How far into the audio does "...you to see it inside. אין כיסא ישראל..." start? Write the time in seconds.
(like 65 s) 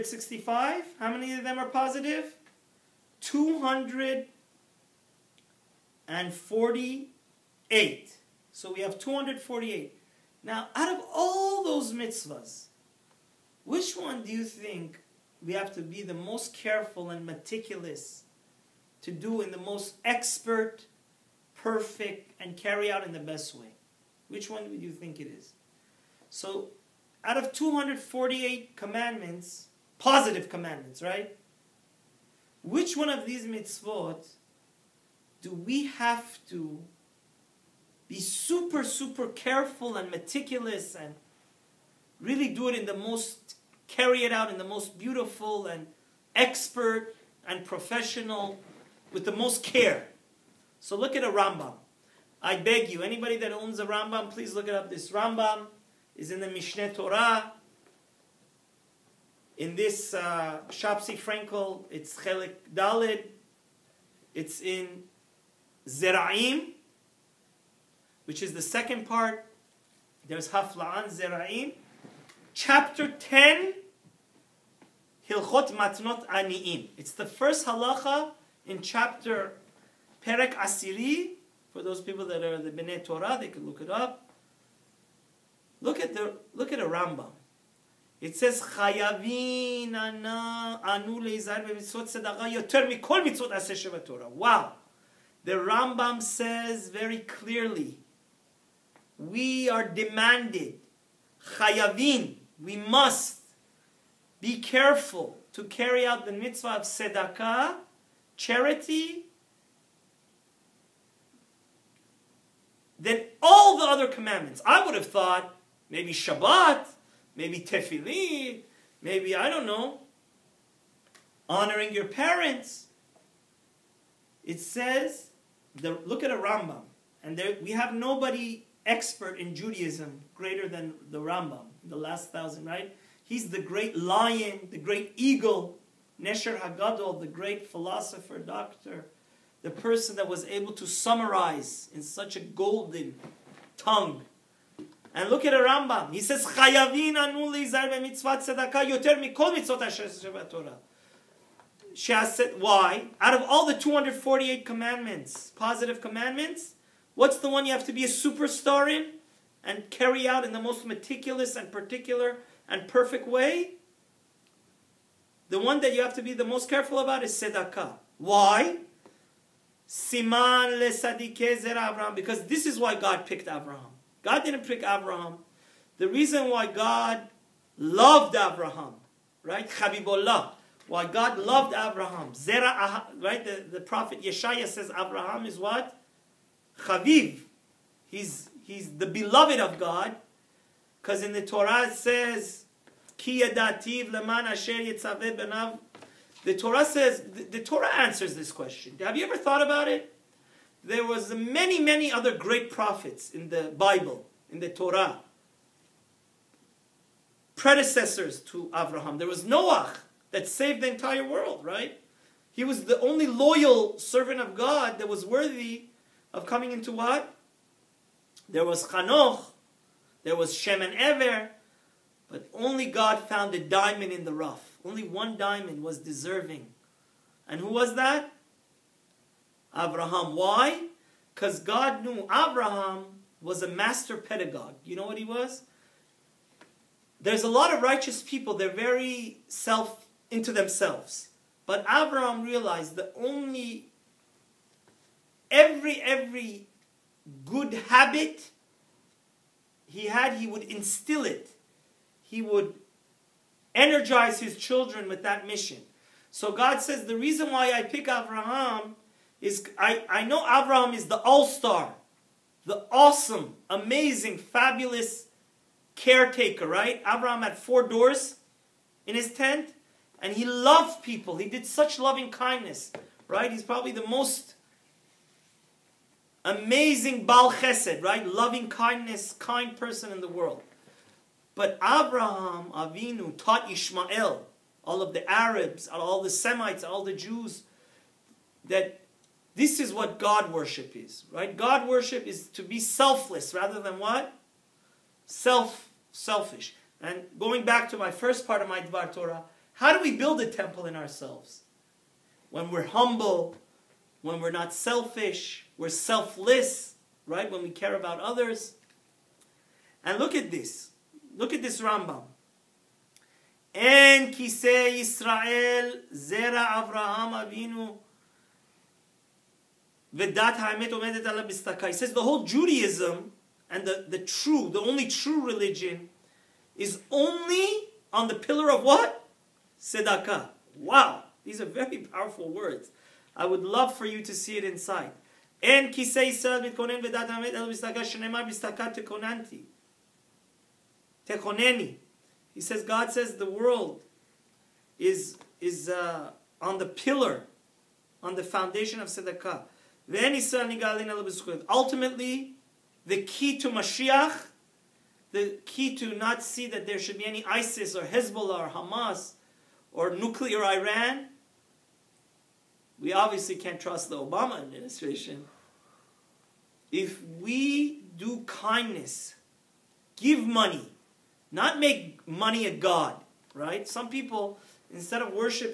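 334 s.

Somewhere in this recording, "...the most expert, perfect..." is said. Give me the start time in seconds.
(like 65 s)
19 s.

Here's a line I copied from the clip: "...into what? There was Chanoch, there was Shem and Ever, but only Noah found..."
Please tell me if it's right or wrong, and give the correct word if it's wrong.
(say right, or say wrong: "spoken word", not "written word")
wrong: "God", not "Noah".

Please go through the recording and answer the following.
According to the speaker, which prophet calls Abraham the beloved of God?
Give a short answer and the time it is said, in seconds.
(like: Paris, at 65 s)
Yeshaya, at 184 s.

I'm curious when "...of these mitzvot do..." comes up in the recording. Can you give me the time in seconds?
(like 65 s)
33 s.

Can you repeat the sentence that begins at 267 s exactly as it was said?
Abraham had four doors in his tent, and he loved people.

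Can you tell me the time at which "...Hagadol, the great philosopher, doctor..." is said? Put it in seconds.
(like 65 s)
136 s.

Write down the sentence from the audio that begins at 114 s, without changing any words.
I would have thought maybe Shabbat, maybe Tefillah, maybe, I don't know, honoring your parents.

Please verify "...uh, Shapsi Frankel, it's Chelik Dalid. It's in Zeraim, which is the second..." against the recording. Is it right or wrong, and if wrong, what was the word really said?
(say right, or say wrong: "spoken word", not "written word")
right.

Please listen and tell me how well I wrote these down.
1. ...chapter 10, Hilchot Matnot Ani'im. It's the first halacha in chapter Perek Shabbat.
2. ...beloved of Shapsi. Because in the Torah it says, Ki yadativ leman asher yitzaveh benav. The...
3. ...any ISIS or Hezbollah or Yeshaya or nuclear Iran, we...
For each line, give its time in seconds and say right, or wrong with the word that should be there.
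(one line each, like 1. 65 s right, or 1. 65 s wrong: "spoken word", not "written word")
1. 72 s wrong: "Asiri", not "Shabbat"
2. 189 s wrong: "God", not "Shapsi"
3. 357 s wrong: "Hamas", not "Yeshaya".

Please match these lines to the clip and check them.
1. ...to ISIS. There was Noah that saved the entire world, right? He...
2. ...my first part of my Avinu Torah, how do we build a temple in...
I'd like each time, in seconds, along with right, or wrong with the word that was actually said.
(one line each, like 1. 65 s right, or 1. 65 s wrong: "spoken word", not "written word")
1. 208 s wrong: "Abraham", not "ISIS"
2. 297 s wrong: "Dvar", not "Avinu".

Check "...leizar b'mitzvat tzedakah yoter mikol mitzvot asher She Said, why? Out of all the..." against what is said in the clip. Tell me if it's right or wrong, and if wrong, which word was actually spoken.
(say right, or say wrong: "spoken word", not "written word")
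right.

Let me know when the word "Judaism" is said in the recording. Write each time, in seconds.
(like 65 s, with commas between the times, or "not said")
129 s, 322 s.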